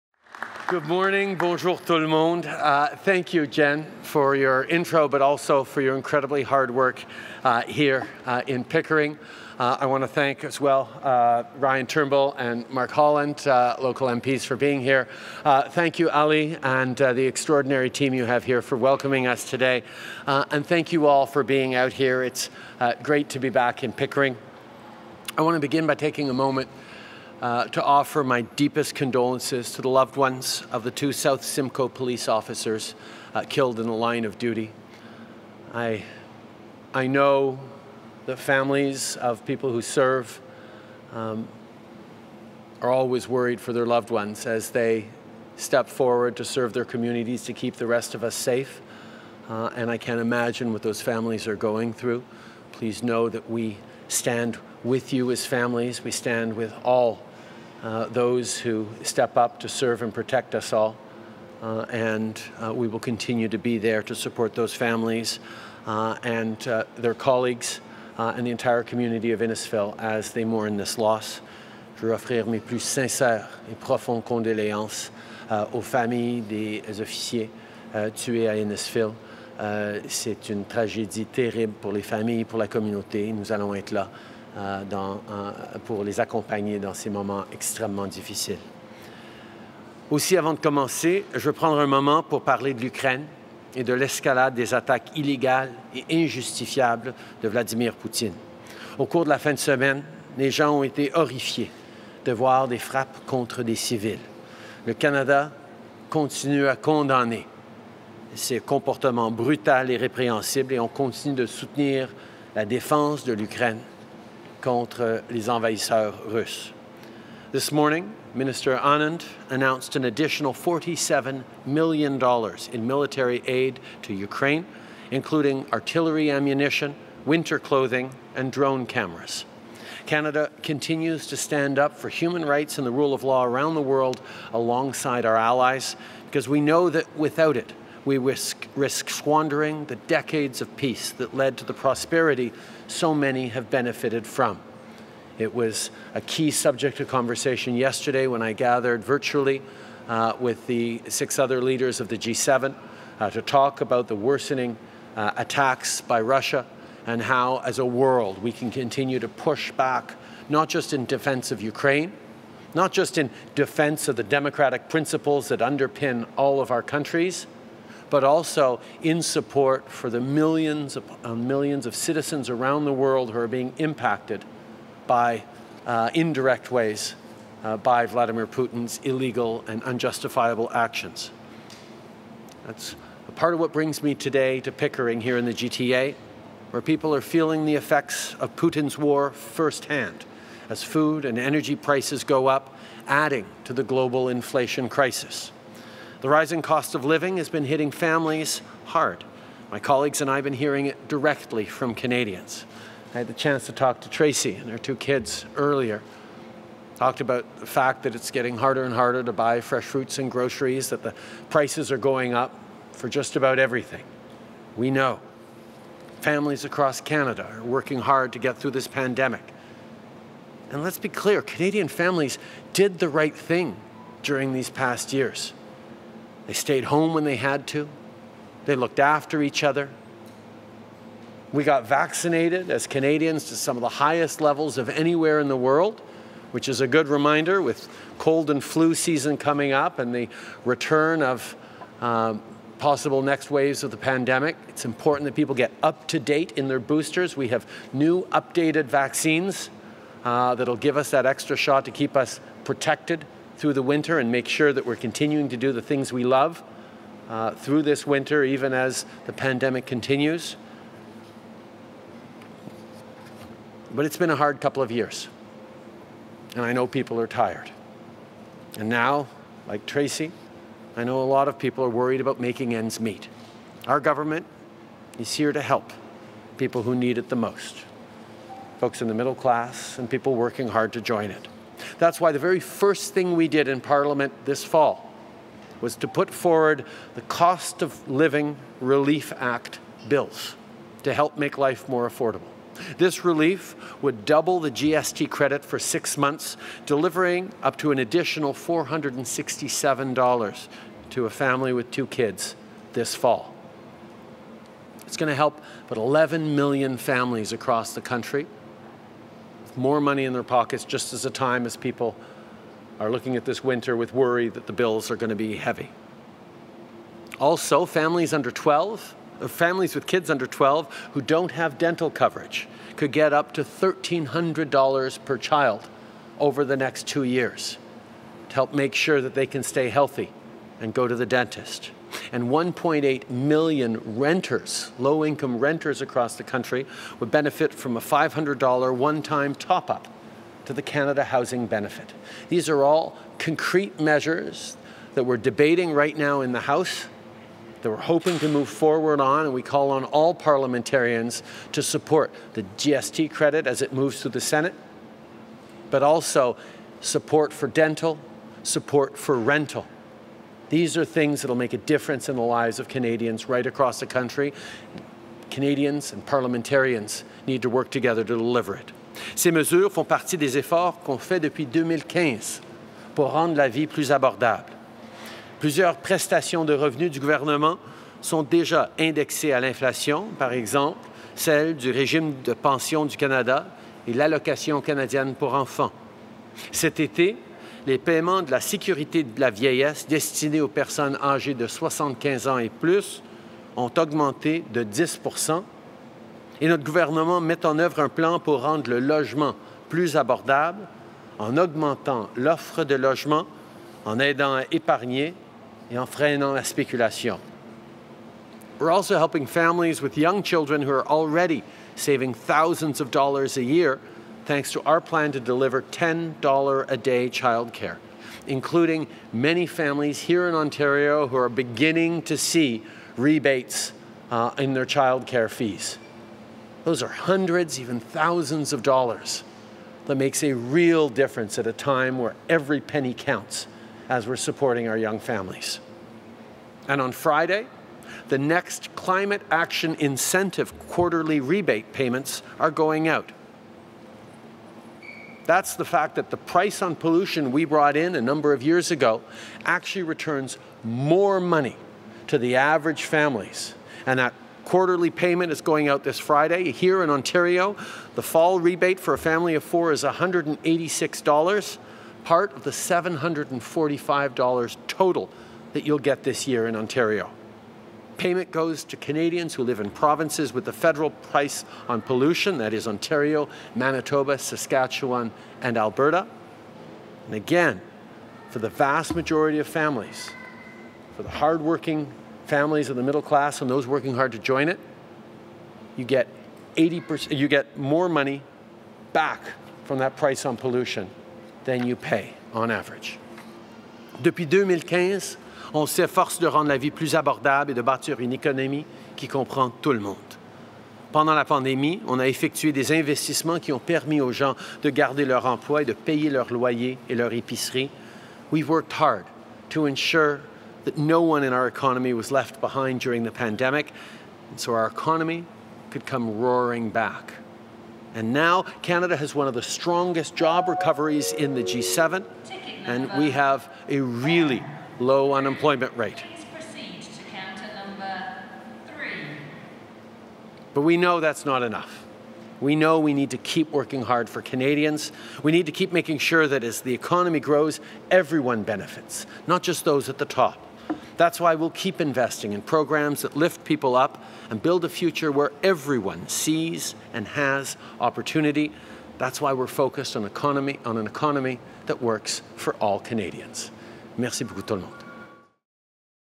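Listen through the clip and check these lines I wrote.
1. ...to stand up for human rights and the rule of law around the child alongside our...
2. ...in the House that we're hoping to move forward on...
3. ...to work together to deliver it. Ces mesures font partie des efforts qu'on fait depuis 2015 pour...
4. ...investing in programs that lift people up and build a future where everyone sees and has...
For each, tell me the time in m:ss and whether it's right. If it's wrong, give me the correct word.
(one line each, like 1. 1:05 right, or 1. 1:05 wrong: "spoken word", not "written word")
1. 2:11 wrong: "world", not "child"
2. 5:46 right
3. 6:07 right
4. 9:01 right.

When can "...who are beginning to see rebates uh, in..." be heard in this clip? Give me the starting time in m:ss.
7:01.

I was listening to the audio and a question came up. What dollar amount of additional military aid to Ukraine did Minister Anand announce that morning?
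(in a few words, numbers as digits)
$47 million.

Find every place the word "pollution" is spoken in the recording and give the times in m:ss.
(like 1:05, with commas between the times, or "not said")
7:26, 7:52, 8:10.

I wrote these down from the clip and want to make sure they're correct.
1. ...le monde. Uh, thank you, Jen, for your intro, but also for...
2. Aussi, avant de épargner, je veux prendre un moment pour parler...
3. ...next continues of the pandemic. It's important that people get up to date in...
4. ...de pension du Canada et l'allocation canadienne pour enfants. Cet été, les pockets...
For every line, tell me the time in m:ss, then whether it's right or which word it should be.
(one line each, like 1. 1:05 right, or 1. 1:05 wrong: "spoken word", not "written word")
1. 0:01 right
2. 1:30 wrong: "commencer", not "épargner"
3. 4:03 wrong: "waves", not "continues"
4. 6:22 wrong: "paiements", not "pockets".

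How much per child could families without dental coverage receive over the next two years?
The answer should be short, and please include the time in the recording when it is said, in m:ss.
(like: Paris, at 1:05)
$1,300, at 5:23.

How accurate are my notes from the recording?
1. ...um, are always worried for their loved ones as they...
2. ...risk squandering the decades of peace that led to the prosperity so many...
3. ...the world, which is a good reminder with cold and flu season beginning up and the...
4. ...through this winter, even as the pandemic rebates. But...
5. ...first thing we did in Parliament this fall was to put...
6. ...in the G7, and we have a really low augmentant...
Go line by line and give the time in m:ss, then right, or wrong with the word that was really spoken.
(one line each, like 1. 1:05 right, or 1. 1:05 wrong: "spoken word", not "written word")
1. 0:41 right
2. 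2:18 right
3. 3:55 wrong: "coming", not "beginning"
4. 4:17 wrong: "continues", not "rebates"
5. 4:42 right
6. 8:41 wrong: "unemployment", not "augmentant".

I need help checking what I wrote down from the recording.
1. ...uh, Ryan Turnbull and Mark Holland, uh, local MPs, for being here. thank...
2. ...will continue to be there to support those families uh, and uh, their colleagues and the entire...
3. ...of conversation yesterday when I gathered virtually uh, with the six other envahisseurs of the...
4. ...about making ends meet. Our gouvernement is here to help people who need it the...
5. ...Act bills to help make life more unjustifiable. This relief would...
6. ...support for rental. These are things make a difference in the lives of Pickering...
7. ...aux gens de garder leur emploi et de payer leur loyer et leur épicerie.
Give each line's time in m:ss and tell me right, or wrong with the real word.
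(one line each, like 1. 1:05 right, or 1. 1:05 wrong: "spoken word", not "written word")
1. 0:11 right
2. 1:02 right
3. 2:26 wrong: "leaders", not "envahisseurs"
4. 4:32 wrong: "government", not "gouvernement"
5. 4:49 wrong: "affordable", not "unjustifiable"
6. 5:58 wrong: "Canadians", not "Pickering"
7. 8:24 right.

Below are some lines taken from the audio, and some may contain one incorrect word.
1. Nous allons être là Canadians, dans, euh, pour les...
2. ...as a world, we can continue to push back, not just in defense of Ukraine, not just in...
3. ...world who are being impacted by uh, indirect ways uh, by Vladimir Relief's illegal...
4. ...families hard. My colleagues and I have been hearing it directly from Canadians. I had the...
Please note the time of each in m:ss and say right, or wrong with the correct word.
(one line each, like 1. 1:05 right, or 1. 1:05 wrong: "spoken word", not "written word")
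1. 1:23 wrong: "Euh", not "Canadians"
2. 2:37 right
3. 2:52 wrong: "Putin", not "Relief"
4. 3:17 right.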